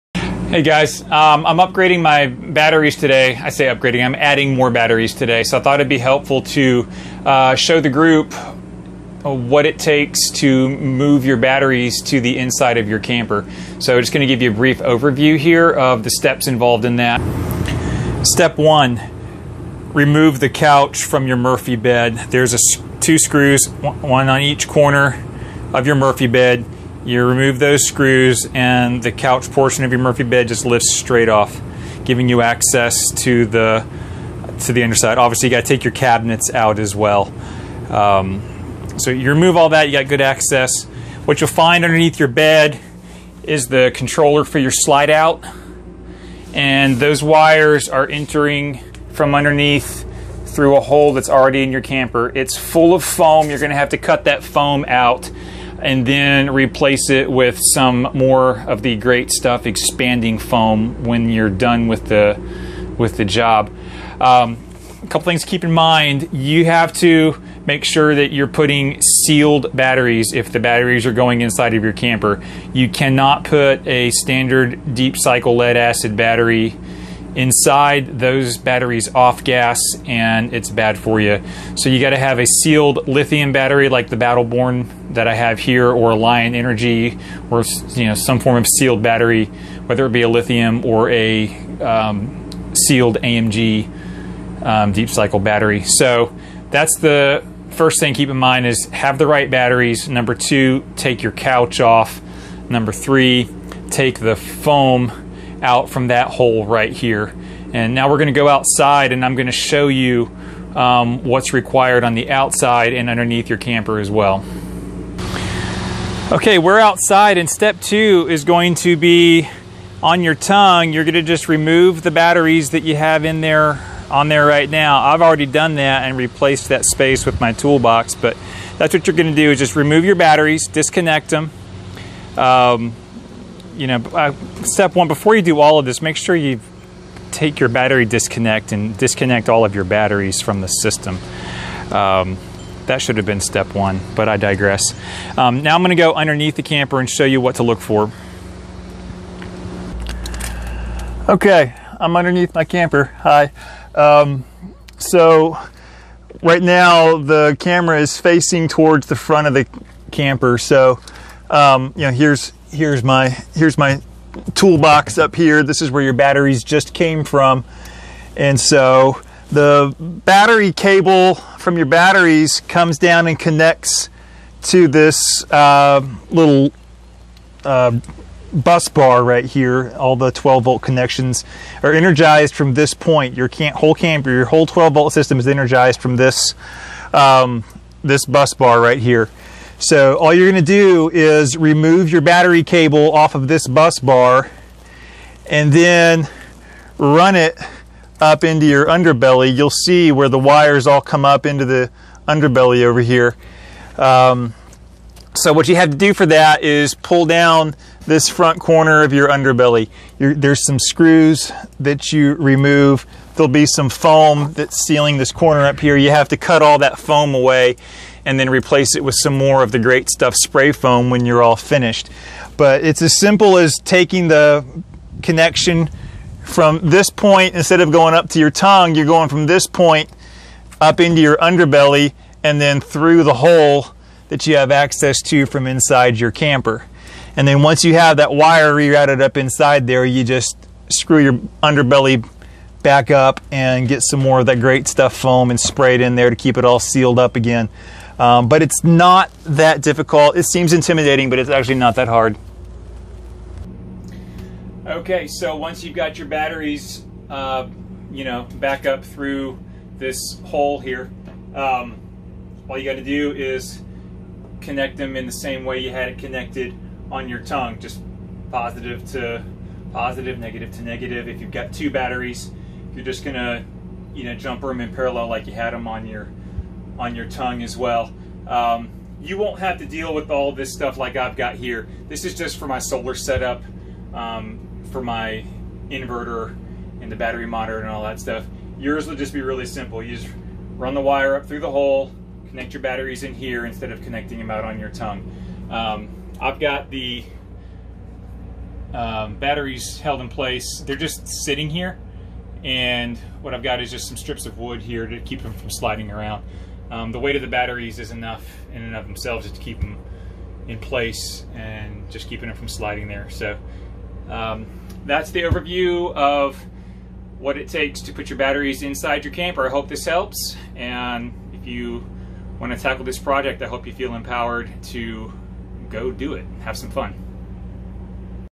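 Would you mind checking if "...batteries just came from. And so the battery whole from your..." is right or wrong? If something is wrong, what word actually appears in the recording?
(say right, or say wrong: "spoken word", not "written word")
wrong: "cable", not "whole".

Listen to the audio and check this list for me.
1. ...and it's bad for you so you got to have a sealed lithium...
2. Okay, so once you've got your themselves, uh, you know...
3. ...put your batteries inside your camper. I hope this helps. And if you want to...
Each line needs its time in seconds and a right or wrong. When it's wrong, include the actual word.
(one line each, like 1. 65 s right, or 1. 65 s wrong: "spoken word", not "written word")
1. 80 s right
2. 254 s wrong: "batteries", not "themselves"
3. 318 s right.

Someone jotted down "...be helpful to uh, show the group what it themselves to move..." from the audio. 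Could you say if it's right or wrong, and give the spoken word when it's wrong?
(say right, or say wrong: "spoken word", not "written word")
wrong: "takes", not "themselves".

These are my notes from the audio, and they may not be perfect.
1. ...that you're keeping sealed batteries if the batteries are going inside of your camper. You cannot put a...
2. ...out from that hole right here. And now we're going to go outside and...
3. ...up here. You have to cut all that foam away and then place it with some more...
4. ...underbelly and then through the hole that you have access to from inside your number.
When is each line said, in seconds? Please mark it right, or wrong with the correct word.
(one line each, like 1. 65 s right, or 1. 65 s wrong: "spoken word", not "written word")
1. 68 s wrong: "putting", not "keeping"
2. 105 s right
3. 215 s wrong: "replace", not "place"
4. 231 s wrong: "camper", not "number".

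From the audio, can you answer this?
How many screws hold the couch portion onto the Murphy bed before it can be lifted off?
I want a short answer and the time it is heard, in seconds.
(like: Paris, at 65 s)
2, at 22 s.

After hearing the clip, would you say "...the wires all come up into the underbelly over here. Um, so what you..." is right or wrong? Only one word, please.
right.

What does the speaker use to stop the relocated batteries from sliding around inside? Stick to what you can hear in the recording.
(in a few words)
Strips of wood.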